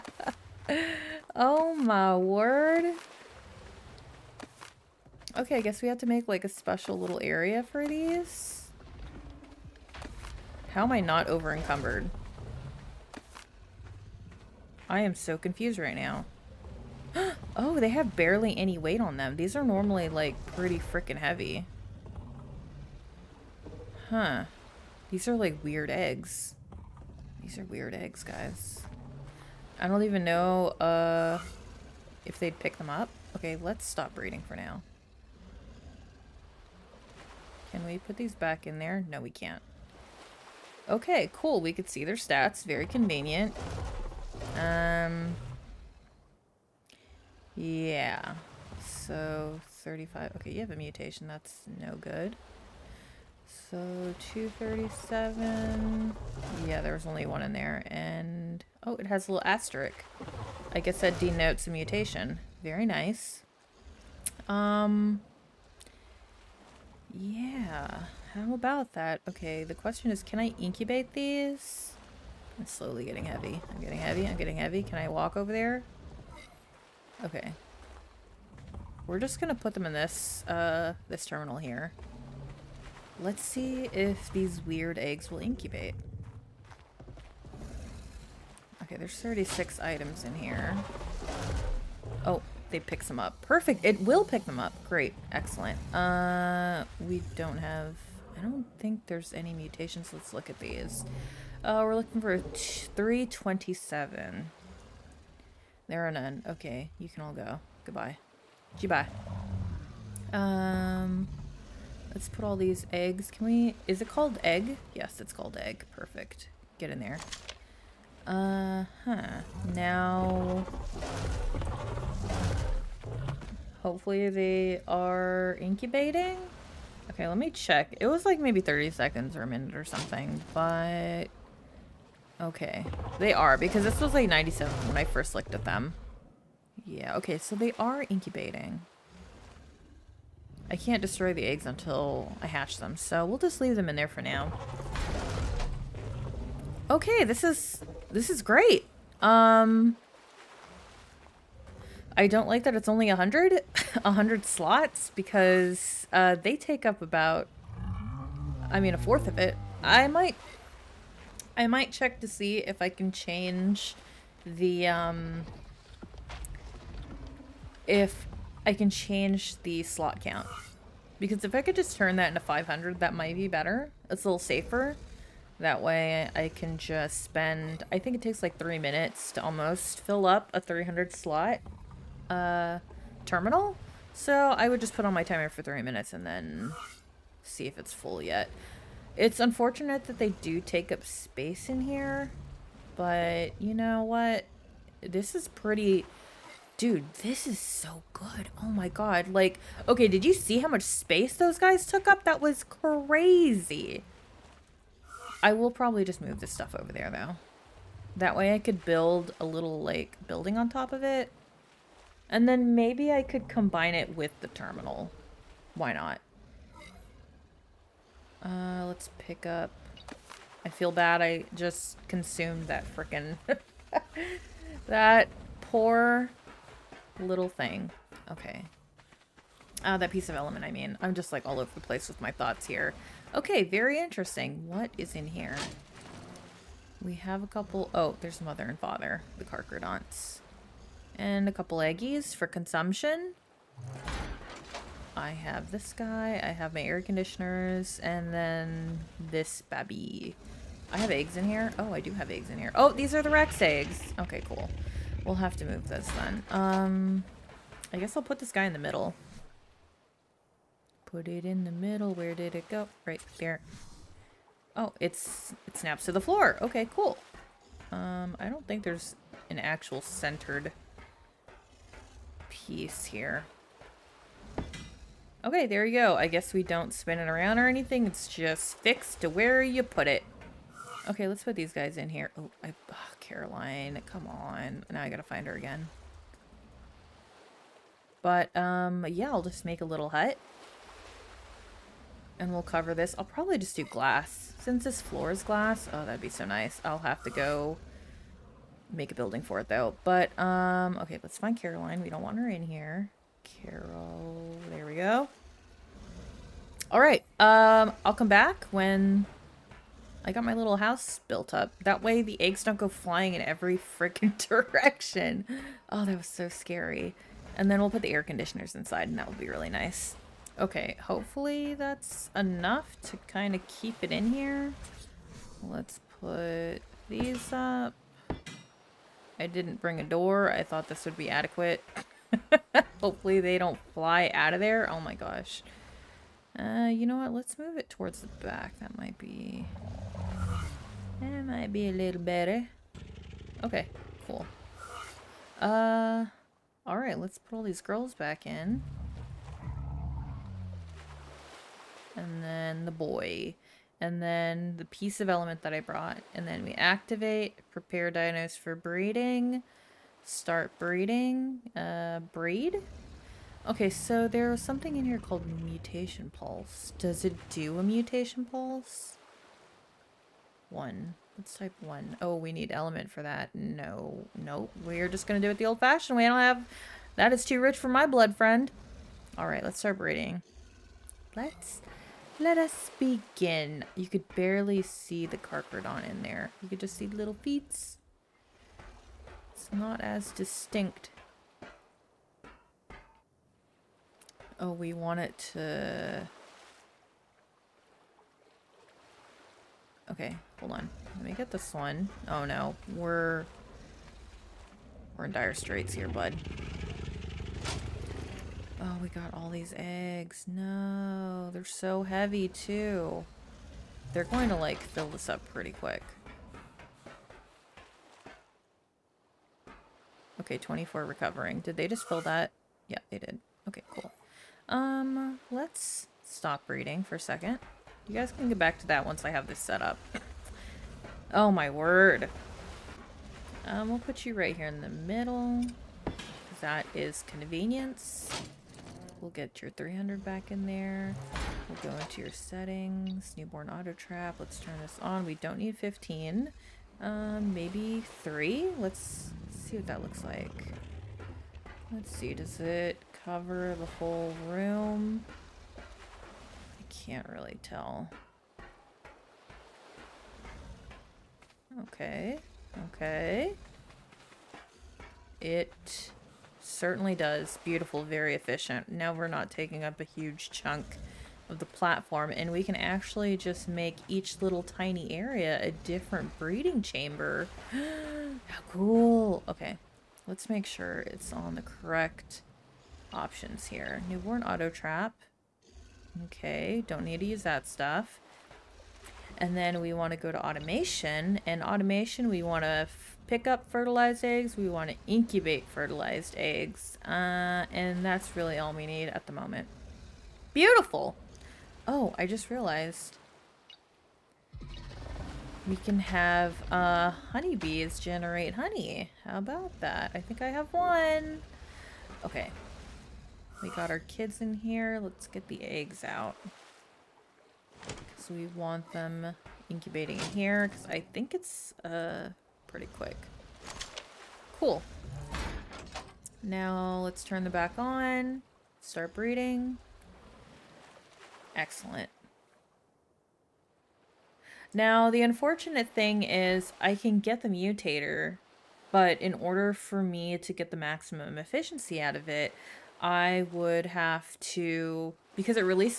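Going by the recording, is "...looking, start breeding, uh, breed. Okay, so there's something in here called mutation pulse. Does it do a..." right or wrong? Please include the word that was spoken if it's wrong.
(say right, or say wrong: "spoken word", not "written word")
wrong: "breeding", not "looking".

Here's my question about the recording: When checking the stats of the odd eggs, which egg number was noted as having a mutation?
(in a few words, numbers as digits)
237.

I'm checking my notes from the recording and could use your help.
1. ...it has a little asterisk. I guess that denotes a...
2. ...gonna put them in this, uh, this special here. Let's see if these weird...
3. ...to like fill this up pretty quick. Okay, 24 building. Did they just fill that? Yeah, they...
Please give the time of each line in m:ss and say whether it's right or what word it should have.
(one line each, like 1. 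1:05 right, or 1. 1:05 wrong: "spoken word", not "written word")
1. 0:58 right
2. 1:19 wrong: "terminal", not "special"
3. 6:54 wrong: "recovering", not "building".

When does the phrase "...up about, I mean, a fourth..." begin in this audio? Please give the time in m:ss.
2:36.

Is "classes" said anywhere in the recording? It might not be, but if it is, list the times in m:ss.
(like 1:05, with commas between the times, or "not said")
not said.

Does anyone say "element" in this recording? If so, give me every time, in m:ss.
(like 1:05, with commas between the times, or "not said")
3:50, 5:55, 6:12.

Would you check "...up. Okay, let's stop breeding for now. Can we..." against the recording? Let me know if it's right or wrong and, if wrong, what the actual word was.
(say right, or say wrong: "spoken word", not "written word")
right.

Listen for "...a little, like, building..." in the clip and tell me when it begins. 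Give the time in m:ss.
3:29.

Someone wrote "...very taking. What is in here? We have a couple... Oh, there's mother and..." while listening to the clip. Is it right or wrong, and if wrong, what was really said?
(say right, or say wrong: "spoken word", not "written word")
wrong: "interesting", not "taking".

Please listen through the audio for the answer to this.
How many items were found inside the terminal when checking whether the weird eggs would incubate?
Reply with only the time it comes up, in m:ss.
1:29.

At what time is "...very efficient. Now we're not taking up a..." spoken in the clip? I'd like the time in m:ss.
7:48.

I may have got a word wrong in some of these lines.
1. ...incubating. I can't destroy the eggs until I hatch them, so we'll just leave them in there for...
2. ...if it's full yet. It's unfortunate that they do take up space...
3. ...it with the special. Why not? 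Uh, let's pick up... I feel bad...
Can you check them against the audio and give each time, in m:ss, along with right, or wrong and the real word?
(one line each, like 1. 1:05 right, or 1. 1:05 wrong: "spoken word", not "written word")
1. 2:18 right
2. 3:07 right
3. 3:33 wrong: "terminal", not "special".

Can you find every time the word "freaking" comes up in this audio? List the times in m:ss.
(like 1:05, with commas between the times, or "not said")
0:20, 5:13.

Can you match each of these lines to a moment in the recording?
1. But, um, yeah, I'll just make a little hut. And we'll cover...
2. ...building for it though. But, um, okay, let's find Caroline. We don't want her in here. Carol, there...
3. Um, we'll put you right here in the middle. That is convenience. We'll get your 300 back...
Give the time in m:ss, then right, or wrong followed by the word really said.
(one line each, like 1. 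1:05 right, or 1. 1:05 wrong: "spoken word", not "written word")
1. 4:48 right
2. 4:59 right
3. 7:13 right.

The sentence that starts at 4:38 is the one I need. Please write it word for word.
It's just fixed to where you put it.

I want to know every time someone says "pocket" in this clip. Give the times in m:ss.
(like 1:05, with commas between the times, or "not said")
not said.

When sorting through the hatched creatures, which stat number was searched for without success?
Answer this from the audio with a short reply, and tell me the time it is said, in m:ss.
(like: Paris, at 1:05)
327, at 1:42.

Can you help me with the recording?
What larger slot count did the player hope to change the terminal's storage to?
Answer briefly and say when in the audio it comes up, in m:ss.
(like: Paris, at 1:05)
500, at 2:52.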